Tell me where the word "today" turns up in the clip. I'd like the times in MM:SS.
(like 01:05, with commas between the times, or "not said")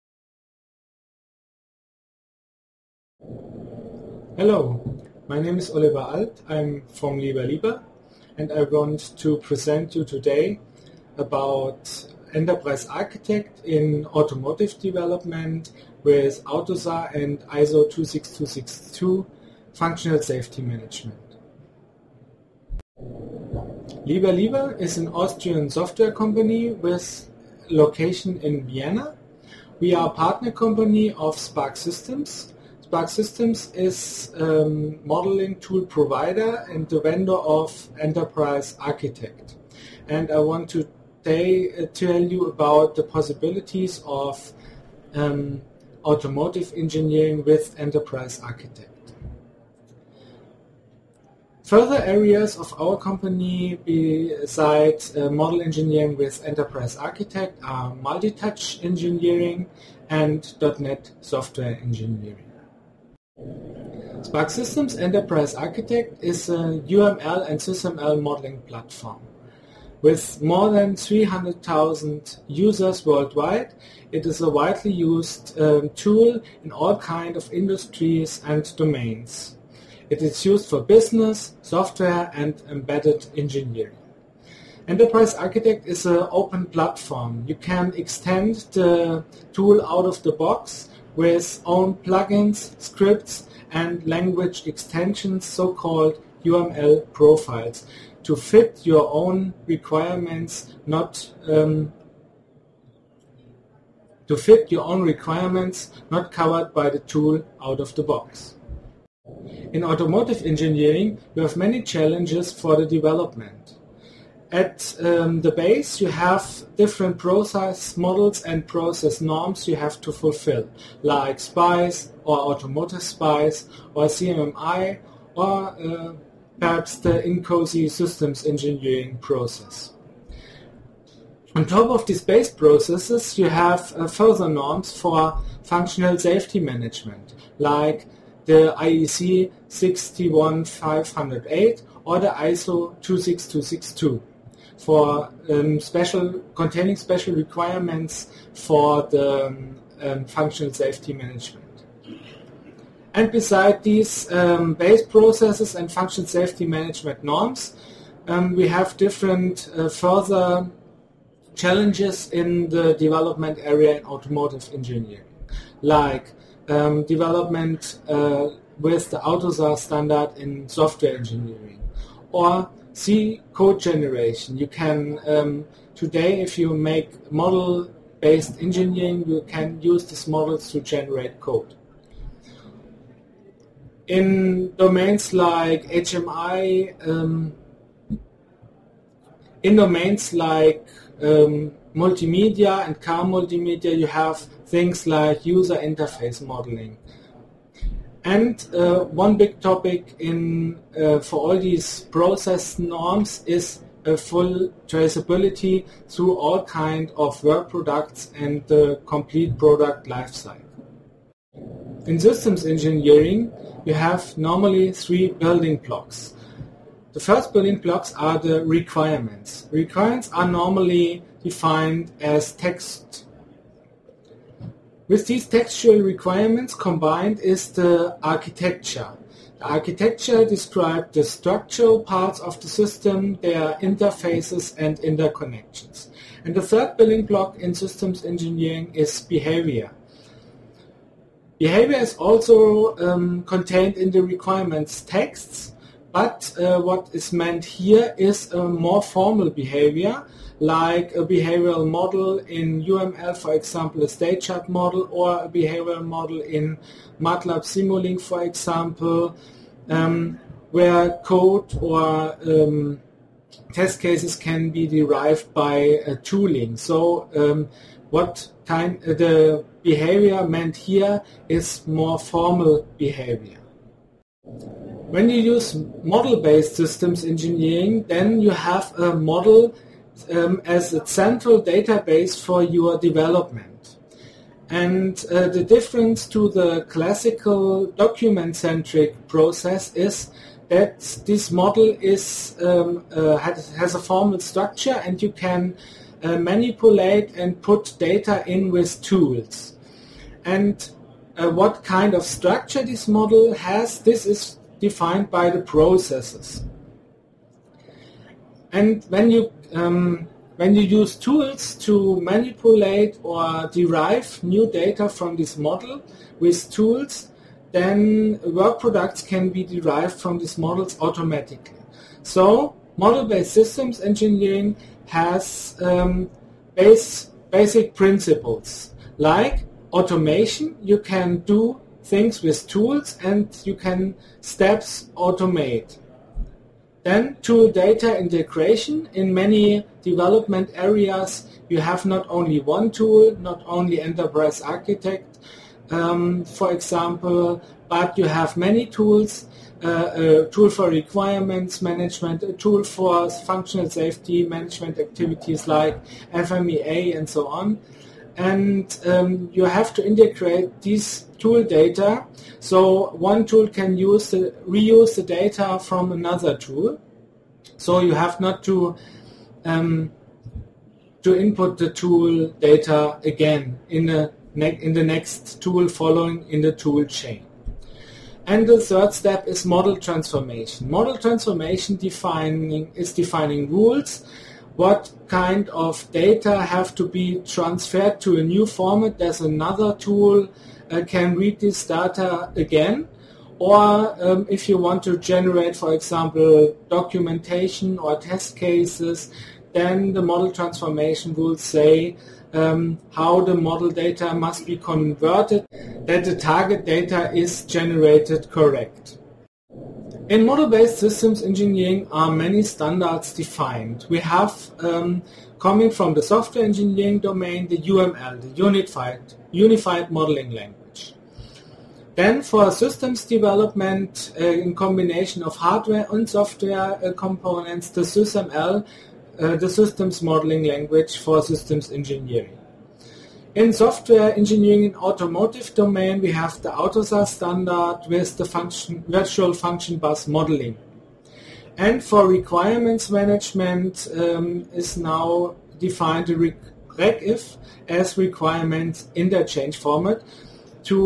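00:10, 02:55.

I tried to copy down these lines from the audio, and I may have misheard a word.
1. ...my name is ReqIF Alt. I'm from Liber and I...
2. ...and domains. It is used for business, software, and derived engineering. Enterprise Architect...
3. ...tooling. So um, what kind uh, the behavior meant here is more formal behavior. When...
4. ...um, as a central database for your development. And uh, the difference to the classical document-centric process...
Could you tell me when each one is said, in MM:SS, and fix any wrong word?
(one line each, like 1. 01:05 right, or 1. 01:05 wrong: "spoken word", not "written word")
1. 00:05 wrong: "Oliver", not "ReqIF"
2. 01:18 wrong: "embedded", not "derived"
3. 04:26 right
4. 04:40 right.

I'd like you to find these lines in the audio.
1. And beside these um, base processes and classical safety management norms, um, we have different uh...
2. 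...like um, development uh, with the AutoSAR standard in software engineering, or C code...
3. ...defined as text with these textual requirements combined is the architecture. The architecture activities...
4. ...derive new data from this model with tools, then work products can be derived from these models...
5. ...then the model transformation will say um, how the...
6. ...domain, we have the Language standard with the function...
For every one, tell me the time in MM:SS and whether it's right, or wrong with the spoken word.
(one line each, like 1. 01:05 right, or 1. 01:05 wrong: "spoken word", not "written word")
1. 02:33 wrong: "functional", not "classical"
2. 02:45 right
3. 03:41 wrong: "describes", not "activities"
4. 05:13 right
5. 06:39 right
6. 07:15 wrong: "AutoSAR", not "Language".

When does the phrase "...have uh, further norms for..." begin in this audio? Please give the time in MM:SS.
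02:13.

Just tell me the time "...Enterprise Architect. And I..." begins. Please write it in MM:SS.
00:37.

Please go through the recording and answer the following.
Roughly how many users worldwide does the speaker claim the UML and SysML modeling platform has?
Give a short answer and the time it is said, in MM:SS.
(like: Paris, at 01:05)
300,000, at 01:10.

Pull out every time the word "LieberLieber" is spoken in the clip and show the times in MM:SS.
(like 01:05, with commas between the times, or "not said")
00:24.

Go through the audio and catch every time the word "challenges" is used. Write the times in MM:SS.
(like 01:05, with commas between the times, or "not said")
01:51, 02:41.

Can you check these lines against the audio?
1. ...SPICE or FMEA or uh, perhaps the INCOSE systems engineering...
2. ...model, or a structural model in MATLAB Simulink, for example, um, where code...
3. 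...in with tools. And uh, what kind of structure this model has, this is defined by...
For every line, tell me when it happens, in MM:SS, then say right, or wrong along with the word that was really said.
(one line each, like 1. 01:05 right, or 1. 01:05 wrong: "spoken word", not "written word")
1. 02:03 wrong: "CMMI", not "FMEA"
2. 04:14 wrong: "behavioral", not "structural"
3. 04:58 right.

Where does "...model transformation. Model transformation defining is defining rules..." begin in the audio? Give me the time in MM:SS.
06:19.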